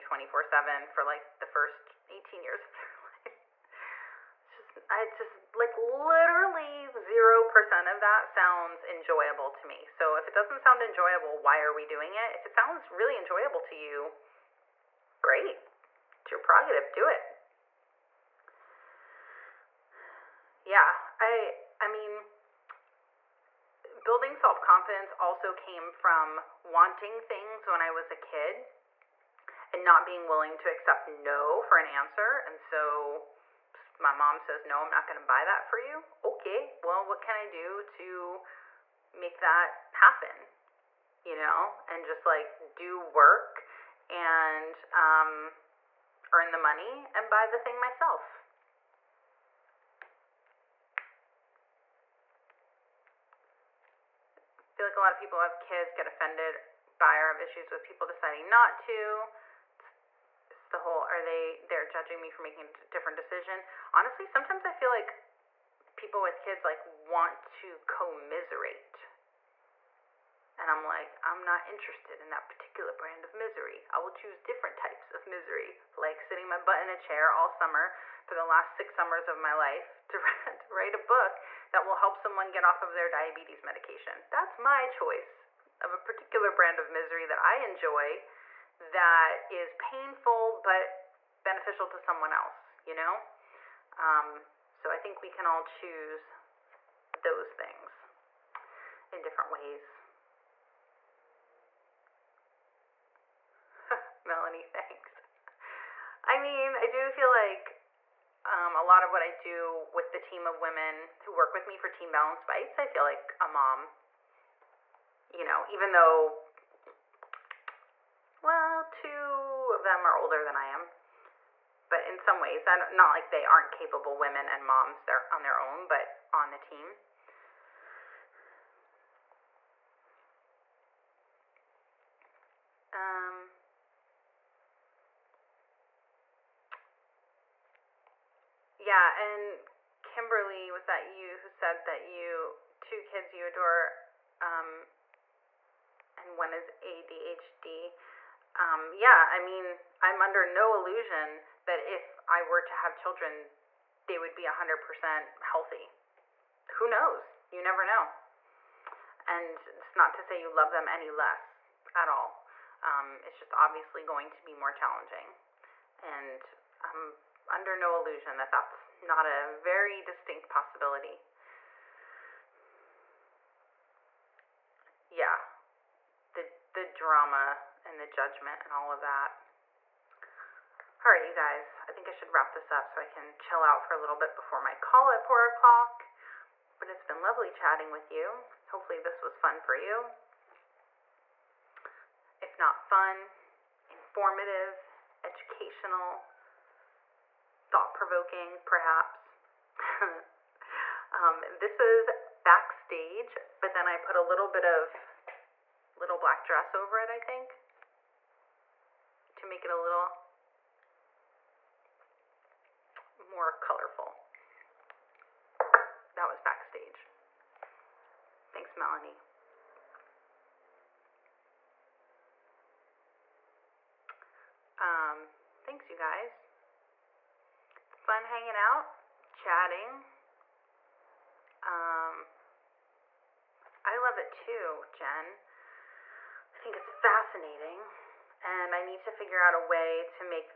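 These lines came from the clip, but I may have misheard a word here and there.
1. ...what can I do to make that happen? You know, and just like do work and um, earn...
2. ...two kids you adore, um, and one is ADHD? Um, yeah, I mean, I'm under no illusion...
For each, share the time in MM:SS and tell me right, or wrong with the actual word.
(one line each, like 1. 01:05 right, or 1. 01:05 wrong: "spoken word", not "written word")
1. 00:37 right
2. 02:22 right.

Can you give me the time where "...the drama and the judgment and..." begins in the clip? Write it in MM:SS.
02:56.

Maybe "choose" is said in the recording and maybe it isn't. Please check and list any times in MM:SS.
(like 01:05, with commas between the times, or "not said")
01:14, 01:35.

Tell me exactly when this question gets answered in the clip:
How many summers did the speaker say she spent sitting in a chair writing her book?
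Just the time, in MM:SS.
01:18.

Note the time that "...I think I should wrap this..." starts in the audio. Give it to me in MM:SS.
03:01.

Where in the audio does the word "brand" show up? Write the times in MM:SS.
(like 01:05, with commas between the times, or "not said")
01:12, 01:26.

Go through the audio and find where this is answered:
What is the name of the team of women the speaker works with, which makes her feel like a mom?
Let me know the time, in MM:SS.
01:51.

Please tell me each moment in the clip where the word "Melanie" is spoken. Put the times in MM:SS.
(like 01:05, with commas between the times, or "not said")
01:44, 03:38.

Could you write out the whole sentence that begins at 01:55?
You know, even though, well, two of them are older than I am.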